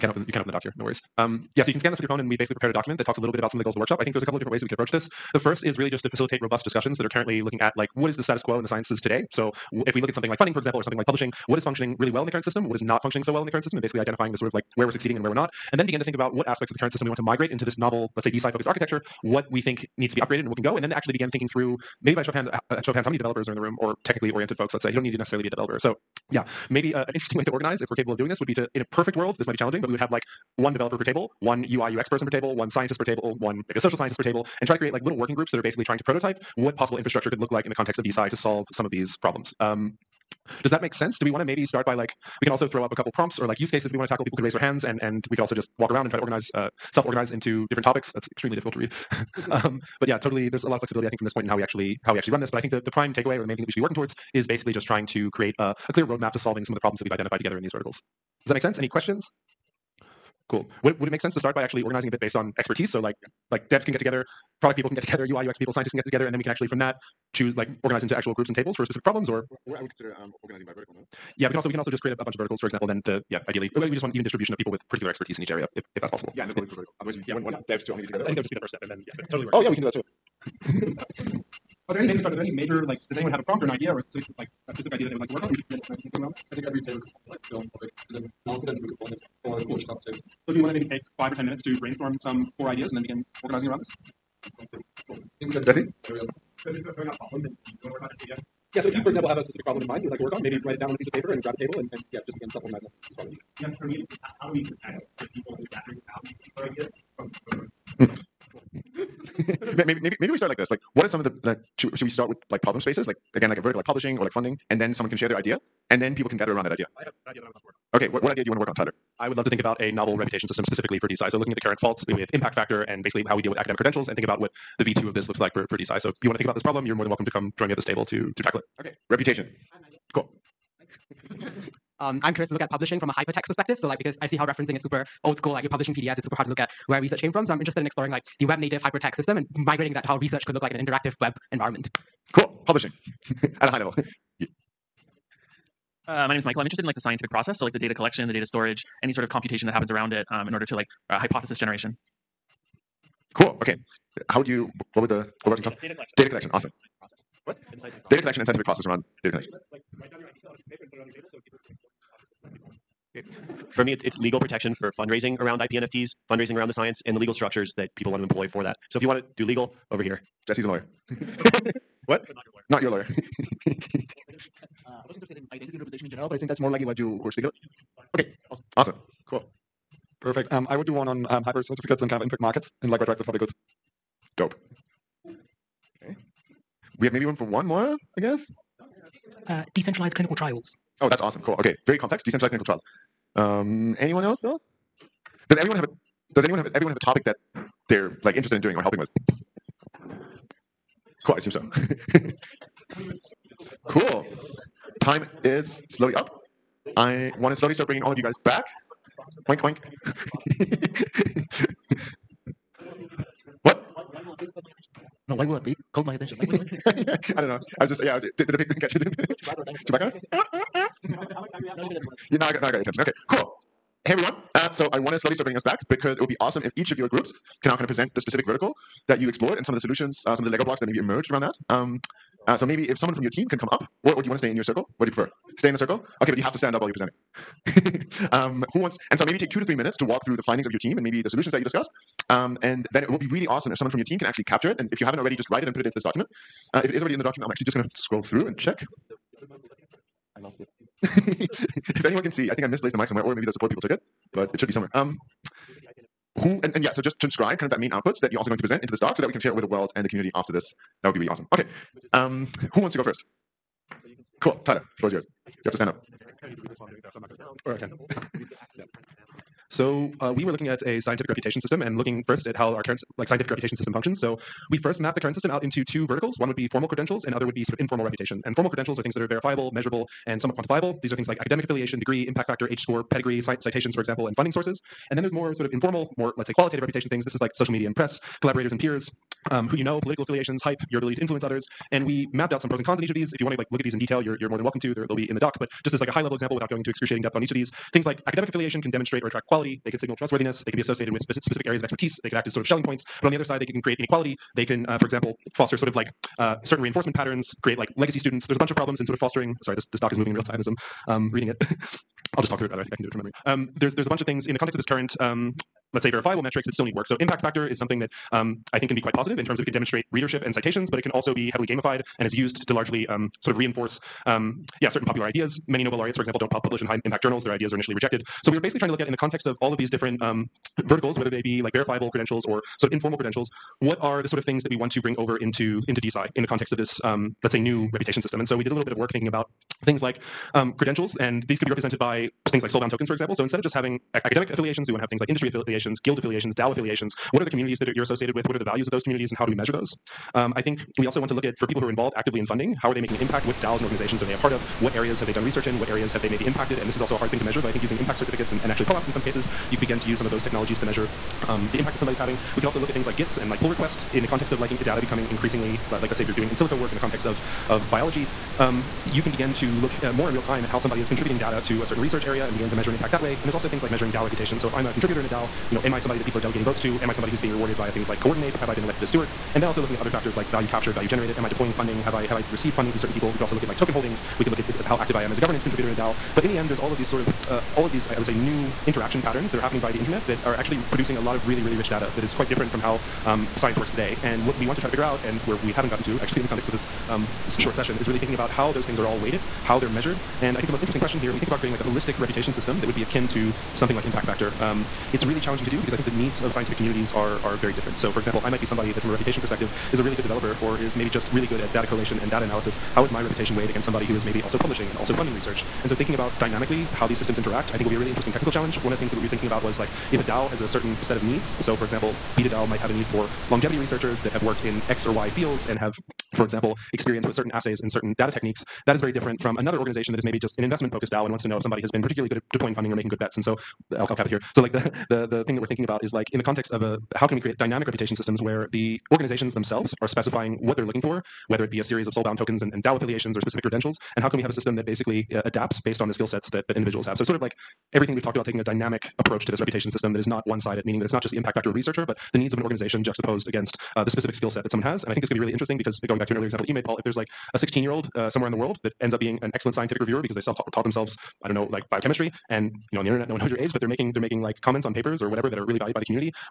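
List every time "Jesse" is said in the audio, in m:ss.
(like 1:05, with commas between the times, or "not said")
1:35, 2:50.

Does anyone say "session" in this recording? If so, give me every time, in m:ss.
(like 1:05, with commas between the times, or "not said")
6:37.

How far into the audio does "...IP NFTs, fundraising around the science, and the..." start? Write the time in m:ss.
2:45.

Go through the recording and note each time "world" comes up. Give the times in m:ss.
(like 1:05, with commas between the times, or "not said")
0:29, 4:19, 7:38.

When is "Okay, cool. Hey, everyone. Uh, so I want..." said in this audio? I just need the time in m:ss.
3:42.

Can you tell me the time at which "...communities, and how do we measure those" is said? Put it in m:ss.
5:49.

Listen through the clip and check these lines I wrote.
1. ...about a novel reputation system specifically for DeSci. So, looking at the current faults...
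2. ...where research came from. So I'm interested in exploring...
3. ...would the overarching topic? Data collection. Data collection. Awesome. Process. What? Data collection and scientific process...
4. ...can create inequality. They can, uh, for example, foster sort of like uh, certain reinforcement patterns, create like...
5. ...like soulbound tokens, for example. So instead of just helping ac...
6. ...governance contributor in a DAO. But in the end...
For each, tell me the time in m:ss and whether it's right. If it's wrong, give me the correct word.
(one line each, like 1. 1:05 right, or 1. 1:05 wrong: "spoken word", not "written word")
1. 1:59 right
2. 2:16 right
3. 2:35 right
4. 5:03 right
5. 5:42 wrong: "having", not "helping"
6. 6:25 right.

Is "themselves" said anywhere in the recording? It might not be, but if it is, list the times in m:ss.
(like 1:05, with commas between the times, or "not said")
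7:19, 7:40.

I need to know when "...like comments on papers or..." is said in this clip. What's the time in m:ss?
7:44.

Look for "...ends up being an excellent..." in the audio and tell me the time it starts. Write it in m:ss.
7:39.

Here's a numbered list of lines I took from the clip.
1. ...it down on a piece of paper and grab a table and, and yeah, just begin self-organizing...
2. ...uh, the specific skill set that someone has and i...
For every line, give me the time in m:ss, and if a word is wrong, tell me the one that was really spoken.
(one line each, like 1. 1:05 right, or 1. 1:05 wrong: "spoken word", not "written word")
1. 1:40 right
2. 7:33 right.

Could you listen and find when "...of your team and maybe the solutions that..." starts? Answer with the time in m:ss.
4:00.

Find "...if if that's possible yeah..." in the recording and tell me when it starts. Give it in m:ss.
1:15.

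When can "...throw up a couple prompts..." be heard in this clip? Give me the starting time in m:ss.
0:42.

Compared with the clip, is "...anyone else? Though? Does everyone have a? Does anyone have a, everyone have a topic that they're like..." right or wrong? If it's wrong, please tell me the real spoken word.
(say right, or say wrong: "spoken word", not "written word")
right.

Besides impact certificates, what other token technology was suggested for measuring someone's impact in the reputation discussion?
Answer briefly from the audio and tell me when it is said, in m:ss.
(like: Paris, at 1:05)
POAPs, at 5:58.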